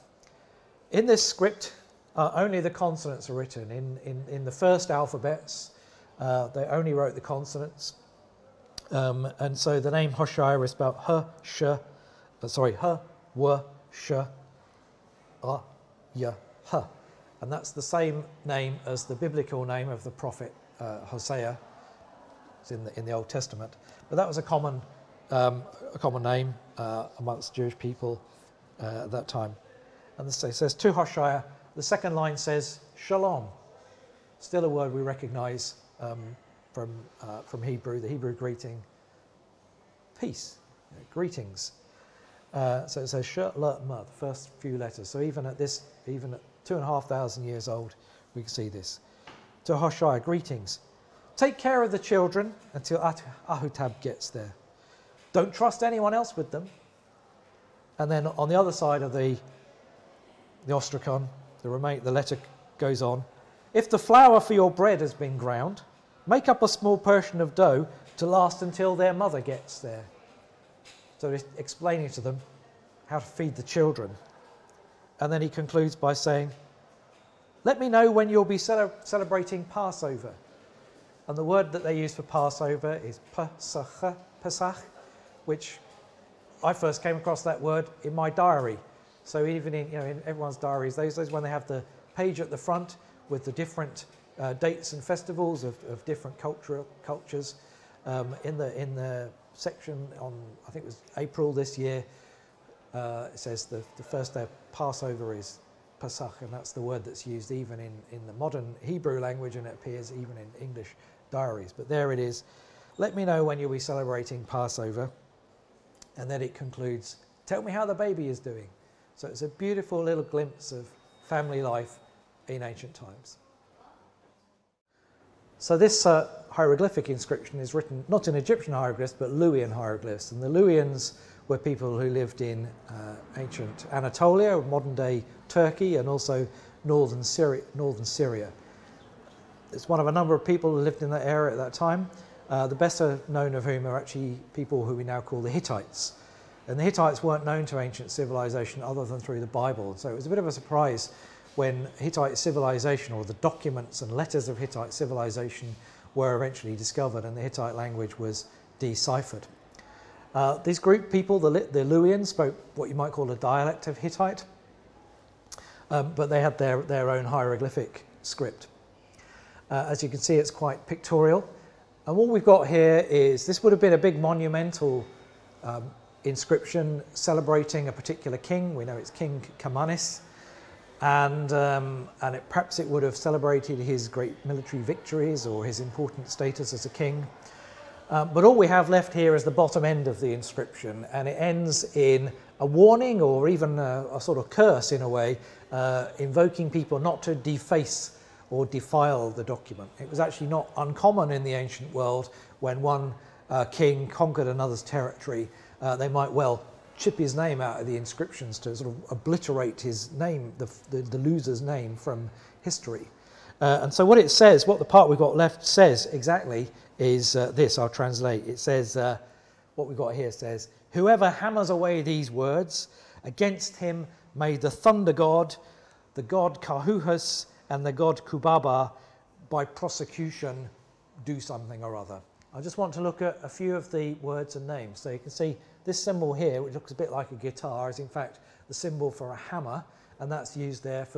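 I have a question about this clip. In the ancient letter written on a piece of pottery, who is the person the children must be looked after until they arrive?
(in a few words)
Ahutab.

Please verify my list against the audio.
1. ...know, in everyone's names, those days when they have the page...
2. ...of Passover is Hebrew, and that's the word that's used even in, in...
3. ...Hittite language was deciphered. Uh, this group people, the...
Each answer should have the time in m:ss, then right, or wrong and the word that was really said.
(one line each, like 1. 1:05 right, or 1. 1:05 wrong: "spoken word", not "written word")
1. 1:29 wrong: "diaries", not "names"
2. 1:44 wrong: "Pesach", not "Hebrew"
3. 2:37 right.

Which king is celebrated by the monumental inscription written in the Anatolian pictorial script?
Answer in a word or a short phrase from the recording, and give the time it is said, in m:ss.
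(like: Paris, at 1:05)
King Kamanis, at 2:59.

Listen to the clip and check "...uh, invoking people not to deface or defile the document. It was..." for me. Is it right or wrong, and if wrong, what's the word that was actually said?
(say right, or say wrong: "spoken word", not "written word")
right.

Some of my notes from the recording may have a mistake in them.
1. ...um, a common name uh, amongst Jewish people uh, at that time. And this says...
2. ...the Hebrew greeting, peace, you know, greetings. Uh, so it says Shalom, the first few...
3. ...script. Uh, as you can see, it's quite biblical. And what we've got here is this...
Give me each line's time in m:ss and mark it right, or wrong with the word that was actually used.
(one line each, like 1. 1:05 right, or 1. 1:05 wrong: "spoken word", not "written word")
1. 0:25 right
2. 0:38 right
3. 2:48 wrong: "pictorial", not "biblical".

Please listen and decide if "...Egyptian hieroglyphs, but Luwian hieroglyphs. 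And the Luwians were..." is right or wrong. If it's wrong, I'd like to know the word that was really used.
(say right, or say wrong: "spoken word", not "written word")
right.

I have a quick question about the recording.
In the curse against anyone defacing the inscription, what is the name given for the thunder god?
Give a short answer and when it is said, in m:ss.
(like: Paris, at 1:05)
Karhuhas, at 3:46.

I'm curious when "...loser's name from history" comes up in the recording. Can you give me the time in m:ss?
3:31.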